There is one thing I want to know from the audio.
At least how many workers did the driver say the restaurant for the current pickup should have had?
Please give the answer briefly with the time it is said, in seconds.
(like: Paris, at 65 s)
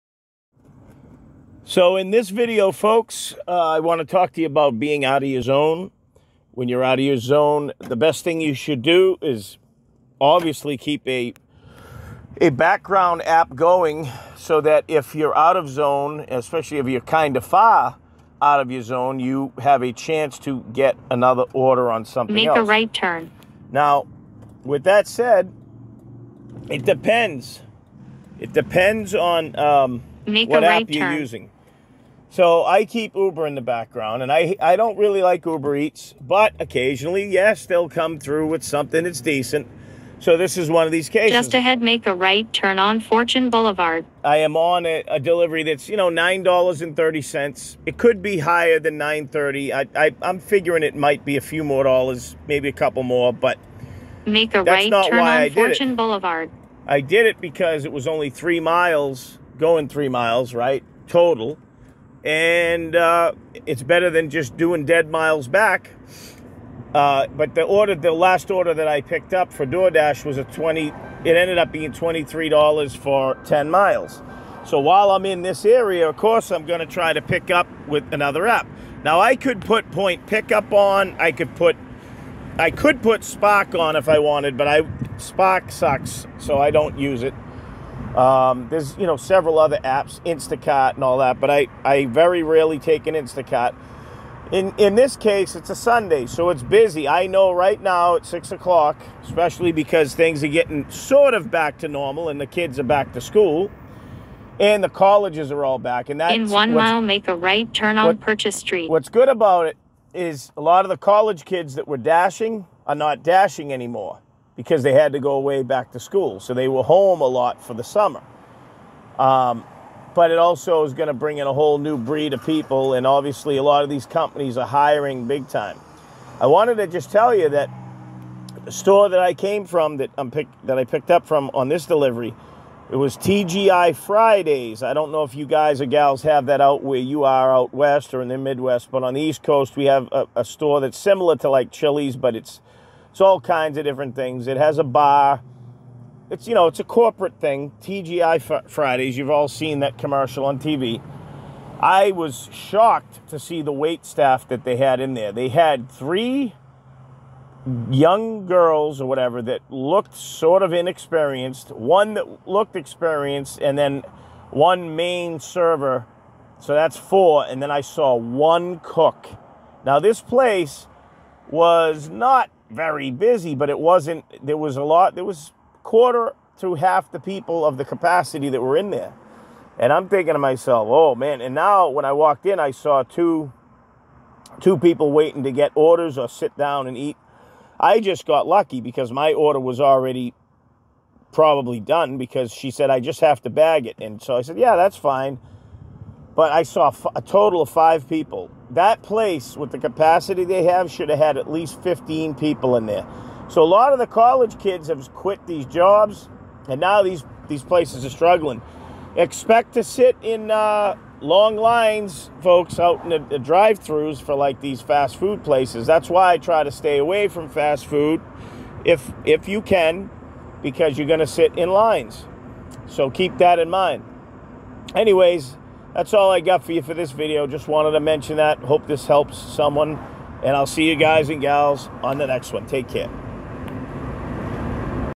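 15, at 201 s.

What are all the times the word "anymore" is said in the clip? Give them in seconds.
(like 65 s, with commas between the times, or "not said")
113 s.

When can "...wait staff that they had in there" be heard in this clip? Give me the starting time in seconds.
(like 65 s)
153 s.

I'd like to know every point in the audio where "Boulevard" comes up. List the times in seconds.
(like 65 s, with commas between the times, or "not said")
43 s, 55 s.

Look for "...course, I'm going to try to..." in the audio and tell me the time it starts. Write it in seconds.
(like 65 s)
76 s.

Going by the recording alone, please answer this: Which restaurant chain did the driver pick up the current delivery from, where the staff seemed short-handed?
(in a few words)
TGI Fridays.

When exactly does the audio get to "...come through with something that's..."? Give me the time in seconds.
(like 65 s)
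37 s.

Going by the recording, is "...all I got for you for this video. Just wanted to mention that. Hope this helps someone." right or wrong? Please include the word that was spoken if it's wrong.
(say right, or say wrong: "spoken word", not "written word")
right.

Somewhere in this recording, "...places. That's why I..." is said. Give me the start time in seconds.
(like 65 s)
215 s.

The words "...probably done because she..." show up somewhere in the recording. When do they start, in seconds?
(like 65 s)
191 s.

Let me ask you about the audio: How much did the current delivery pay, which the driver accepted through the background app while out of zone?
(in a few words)
$9.30.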